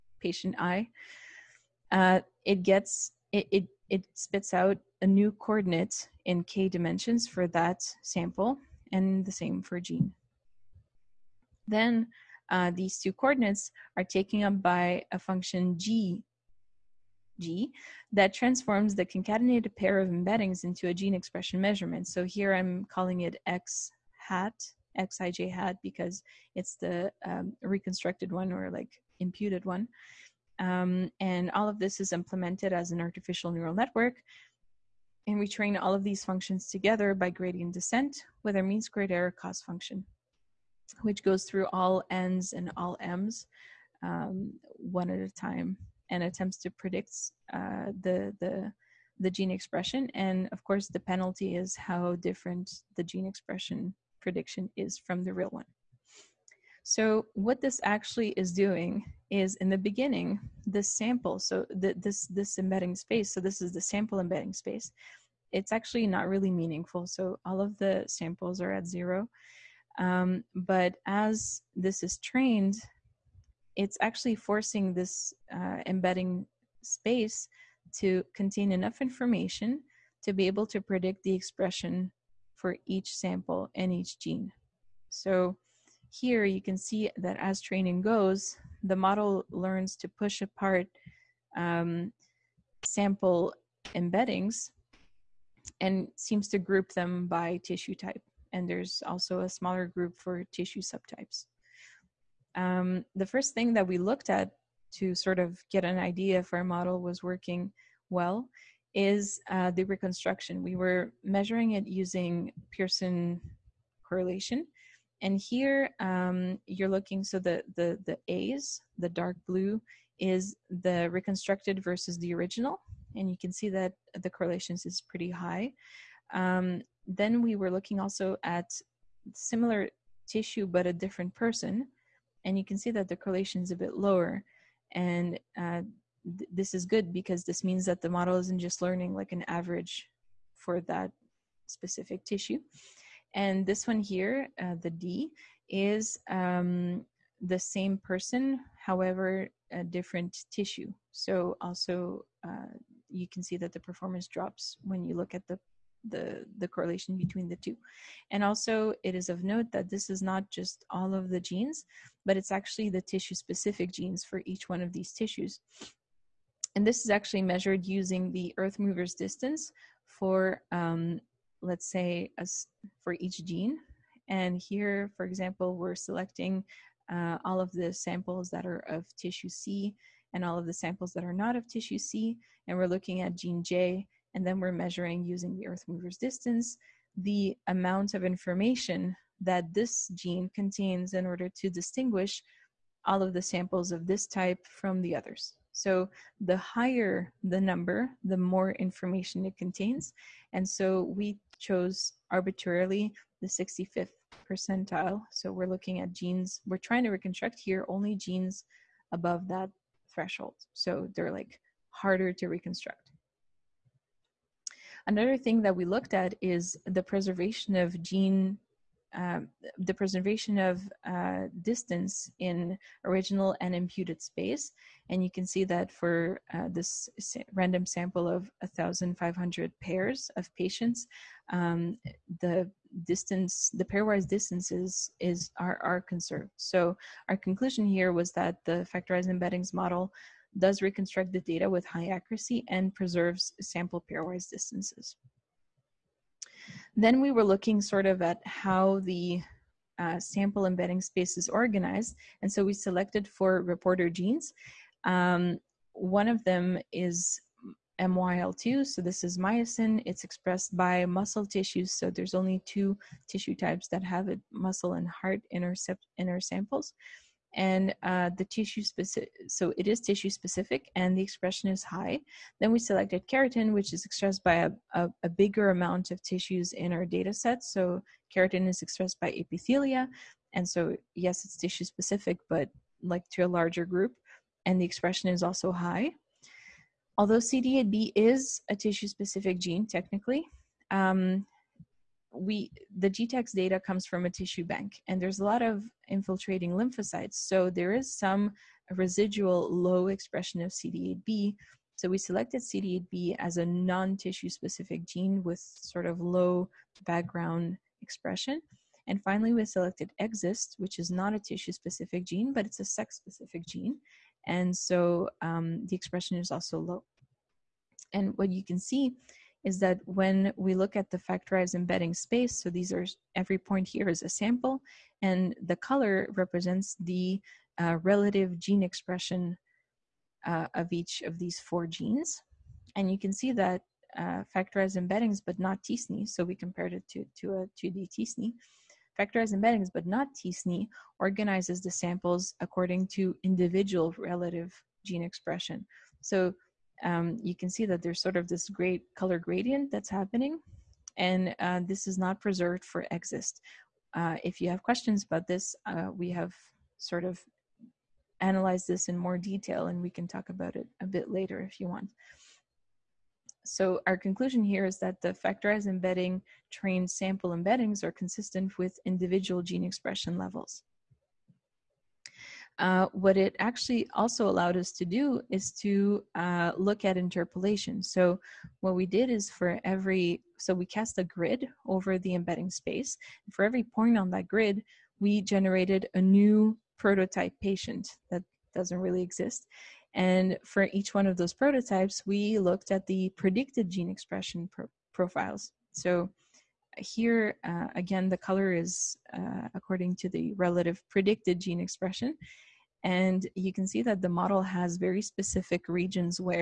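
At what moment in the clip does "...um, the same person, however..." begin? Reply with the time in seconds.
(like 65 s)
146 s.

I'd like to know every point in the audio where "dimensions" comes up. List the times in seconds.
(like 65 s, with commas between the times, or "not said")
6 s.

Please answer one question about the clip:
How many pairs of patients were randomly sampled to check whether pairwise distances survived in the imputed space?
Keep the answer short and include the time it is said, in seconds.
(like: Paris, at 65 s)
1,500, at 228 s.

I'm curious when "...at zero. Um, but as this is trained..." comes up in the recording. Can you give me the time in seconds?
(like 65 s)
68 s.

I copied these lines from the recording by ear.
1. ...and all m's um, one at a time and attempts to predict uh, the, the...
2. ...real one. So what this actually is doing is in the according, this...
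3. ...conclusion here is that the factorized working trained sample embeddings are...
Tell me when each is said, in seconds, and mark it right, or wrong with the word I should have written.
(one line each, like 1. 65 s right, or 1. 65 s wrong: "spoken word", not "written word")
1. 42 s right
2. 55 s wrong: "beginning", not "according"
3. 364 s wrong: "embedding", not "working".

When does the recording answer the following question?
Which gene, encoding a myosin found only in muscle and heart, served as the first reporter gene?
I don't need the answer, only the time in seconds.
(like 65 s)
258 s.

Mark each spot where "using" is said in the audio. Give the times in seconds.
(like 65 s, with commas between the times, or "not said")
111 s, 167 s, 185 s.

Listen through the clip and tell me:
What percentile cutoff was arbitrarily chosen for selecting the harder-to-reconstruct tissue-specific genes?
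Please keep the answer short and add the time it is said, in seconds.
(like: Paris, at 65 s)
65th percentile, at 203 s.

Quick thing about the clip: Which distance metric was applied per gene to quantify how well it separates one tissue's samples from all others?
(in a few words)
Earth mover's distance.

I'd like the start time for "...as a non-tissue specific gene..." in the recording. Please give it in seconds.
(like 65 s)
303 s.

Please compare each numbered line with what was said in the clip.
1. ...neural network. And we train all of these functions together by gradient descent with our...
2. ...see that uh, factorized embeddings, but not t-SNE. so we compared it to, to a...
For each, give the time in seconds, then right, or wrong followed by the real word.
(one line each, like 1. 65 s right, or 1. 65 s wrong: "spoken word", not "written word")
1. 33 s right
2. 333 s right.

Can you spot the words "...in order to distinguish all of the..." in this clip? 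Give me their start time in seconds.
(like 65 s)
191 s.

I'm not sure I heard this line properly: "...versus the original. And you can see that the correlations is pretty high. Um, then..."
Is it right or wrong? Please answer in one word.
right.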